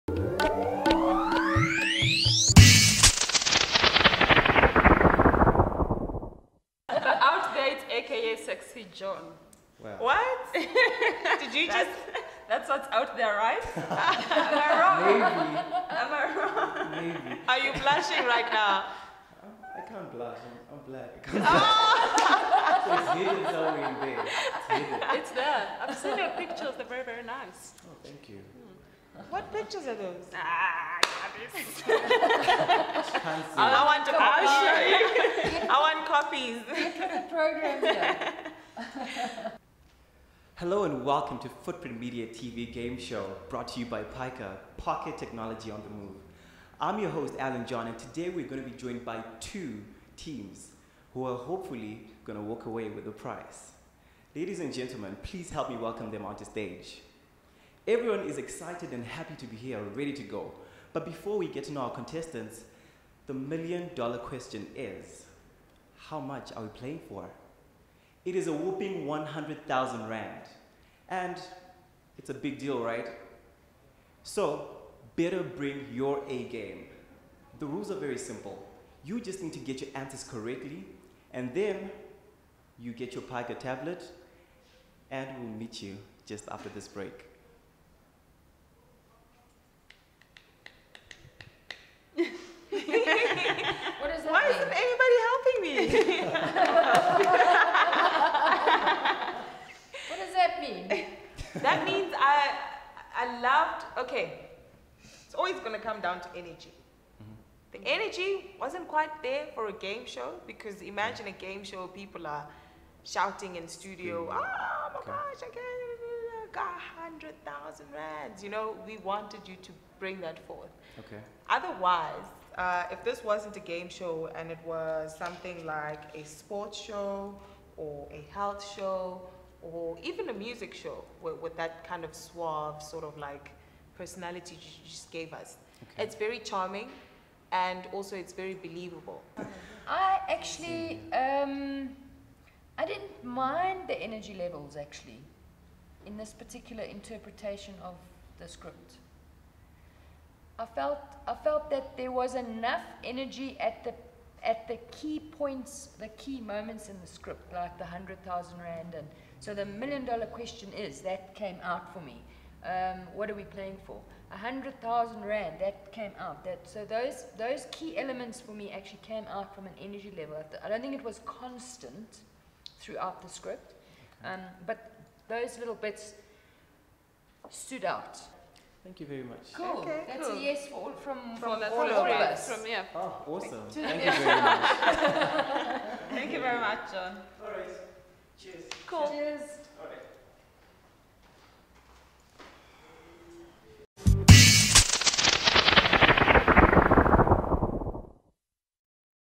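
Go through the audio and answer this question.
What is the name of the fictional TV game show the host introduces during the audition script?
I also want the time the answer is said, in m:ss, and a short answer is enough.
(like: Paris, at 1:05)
Footprint Media TV Game Show, at 0:41.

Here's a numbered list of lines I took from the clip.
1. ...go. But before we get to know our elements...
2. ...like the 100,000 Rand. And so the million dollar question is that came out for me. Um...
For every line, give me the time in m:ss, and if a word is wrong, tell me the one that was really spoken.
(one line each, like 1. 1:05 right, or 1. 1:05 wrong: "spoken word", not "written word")
1. 1:00 wrong: "contestants", not "elements"
2. 2:37 right.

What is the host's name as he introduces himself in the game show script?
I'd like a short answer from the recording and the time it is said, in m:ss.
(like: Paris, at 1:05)
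Alan John, at 0:47.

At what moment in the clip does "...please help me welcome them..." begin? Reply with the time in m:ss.
0:55.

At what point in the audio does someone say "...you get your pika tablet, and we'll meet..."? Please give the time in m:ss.
1:22.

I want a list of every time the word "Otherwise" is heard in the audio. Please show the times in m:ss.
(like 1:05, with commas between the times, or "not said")
2:01.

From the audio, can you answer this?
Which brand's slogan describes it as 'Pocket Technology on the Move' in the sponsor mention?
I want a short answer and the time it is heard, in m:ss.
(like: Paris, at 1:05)
Pica, at 0:44.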